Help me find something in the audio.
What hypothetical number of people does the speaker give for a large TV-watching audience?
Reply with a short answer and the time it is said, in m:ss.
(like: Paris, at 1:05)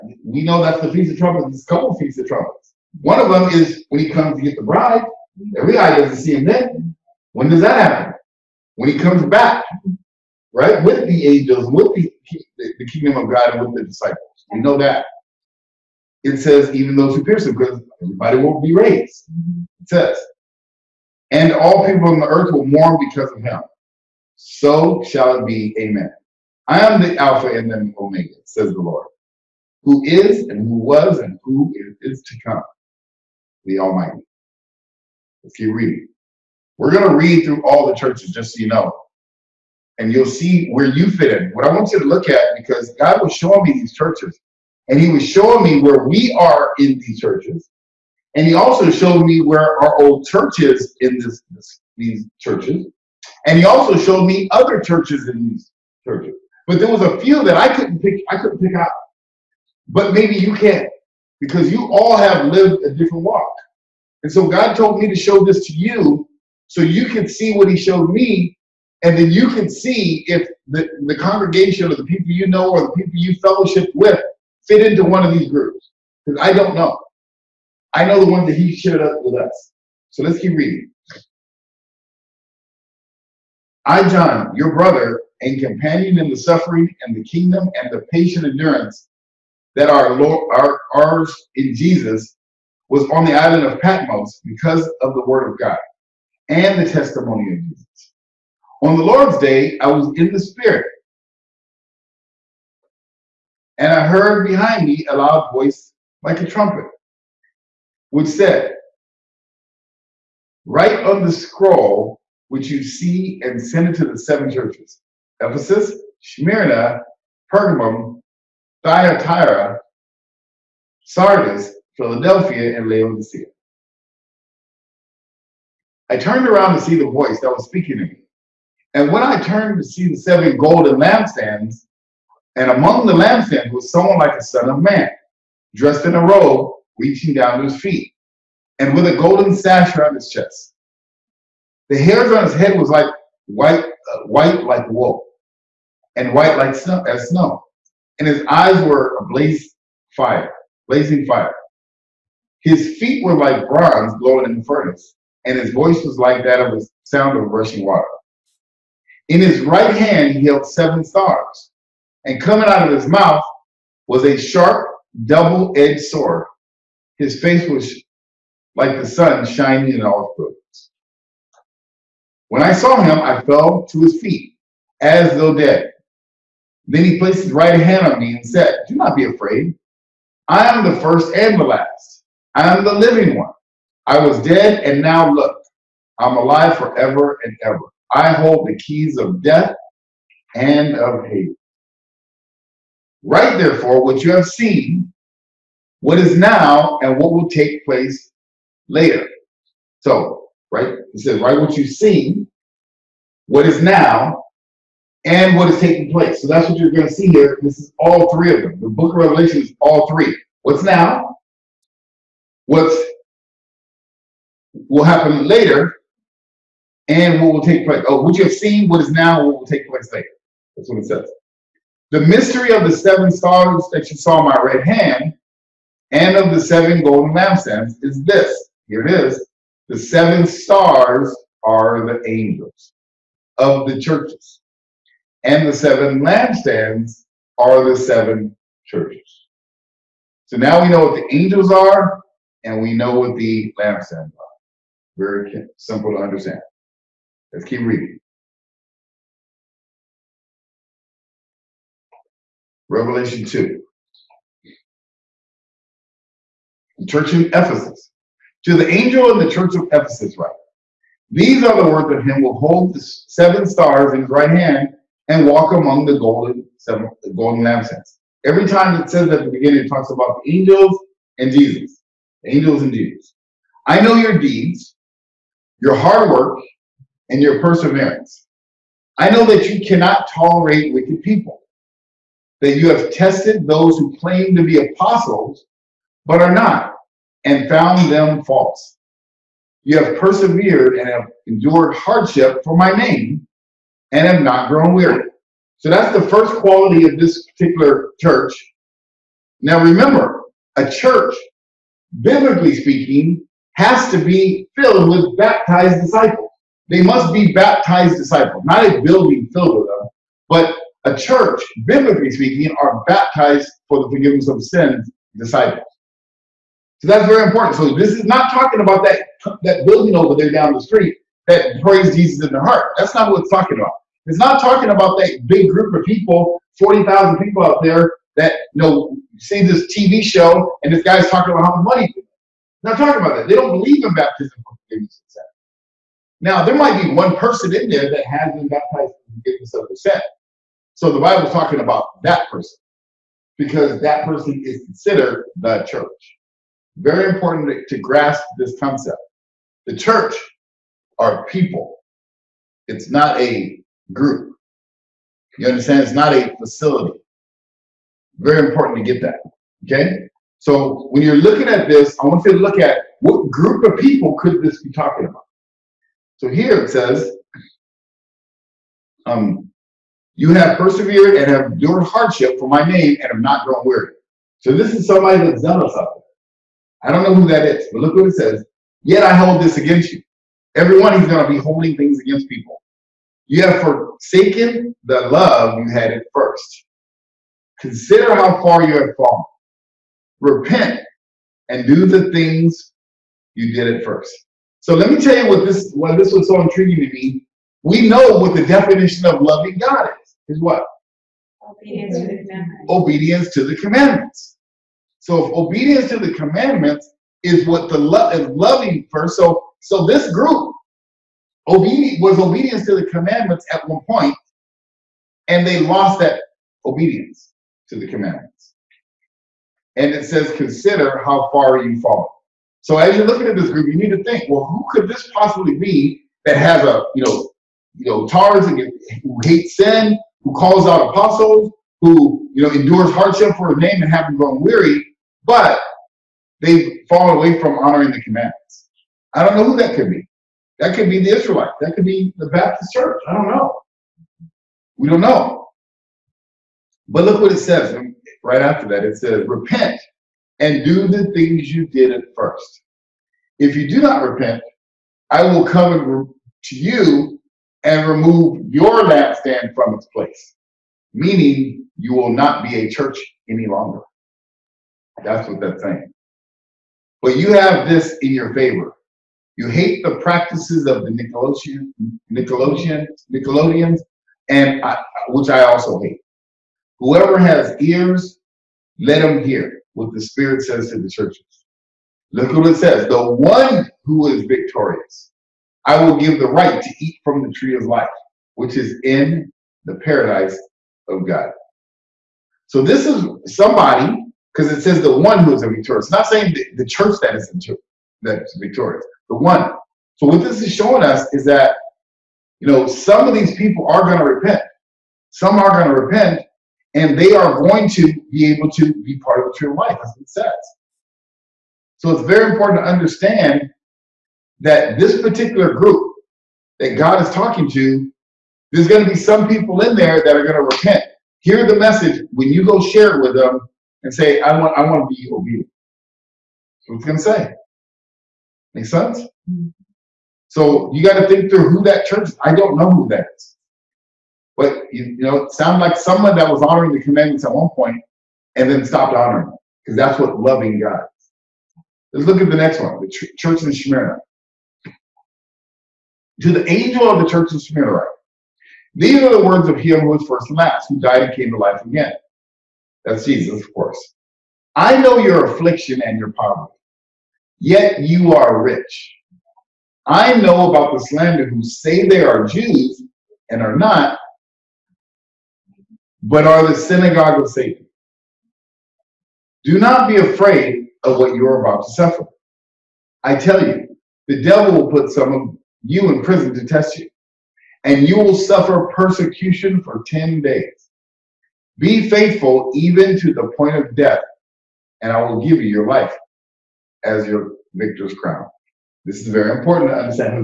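40,000, at 5:26.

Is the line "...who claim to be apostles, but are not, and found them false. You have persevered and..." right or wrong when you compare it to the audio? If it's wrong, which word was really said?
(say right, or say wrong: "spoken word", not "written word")
right.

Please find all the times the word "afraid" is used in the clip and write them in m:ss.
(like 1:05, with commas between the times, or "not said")
2:59, 9:30.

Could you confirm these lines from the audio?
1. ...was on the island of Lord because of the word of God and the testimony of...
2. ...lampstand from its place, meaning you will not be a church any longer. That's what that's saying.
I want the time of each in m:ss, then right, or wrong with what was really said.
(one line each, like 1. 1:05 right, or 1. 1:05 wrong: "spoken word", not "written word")
1. 1:32 wrong: "Patmos", not "Lord"
2. 7:39 right.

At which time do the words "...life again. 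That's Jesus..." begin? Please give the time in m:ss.
9:11.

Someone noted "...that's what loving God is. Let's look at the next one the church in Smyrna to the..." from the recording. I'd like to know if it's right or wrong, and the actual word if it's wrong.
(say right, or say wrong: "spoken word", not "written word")
right.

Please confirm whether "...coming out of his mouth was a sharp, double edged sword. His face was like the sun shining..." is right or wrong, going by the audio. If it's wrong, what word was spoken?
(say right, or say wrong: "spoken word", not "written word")
right.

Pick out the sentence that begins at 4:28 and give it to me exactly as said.
Every time it says at the beginning, it talks about the angels and Jesus.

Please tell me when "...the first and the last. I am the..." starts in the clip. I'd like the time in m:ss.
3:00.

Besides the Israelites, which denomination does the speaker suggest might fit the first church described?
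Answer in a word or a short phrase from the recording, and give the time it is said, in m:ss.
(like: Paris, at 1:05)
Baptist church, at 7:22.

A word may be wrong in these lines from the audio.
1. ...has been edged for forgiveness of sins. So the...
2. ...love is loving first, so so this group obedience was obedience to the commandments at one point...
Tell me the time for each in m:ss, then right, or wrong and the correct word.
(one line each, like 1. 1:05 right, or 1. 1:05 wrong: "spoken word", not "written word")
1. 5:38 wrong: "baptized", not "edged"
2. 6:47 right.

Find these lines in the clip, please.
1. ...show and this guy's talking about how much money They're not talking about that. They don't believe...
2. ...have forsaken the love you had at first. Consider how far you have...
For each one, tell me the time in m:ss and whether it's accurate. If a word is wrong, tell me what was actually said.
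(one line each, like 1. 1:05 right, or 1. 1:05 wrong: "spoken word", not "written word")
1. 5:30 right
2. 6:23 right.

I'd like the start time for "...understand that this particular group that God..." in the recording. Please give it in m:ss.
8:32.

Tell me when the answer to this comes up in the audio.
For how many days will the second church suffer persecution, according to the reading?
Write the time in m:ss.
9:40.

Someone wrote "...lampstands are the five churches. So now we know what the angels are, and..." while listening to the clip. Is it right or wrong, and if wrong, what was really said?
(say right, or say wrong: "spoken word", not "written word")
wrong: "seven", not "five".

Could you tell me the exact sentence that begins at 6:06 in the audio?
So here it says, um, you have persevered and have endured hardship for my name and have not grown weary.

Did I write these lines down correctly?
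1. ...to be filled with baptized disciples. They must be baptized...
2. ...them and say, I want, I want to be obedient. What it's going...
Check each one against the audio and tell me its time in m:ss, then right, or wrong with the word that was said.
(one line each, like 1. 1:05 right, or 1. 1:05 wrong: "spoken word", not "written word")
1. 5:04 right
2. 8:43 right.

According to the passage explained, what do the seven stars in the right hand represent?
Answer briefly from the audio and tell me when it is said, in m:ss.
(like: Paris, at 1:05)
The angels of the churches, at 3:52.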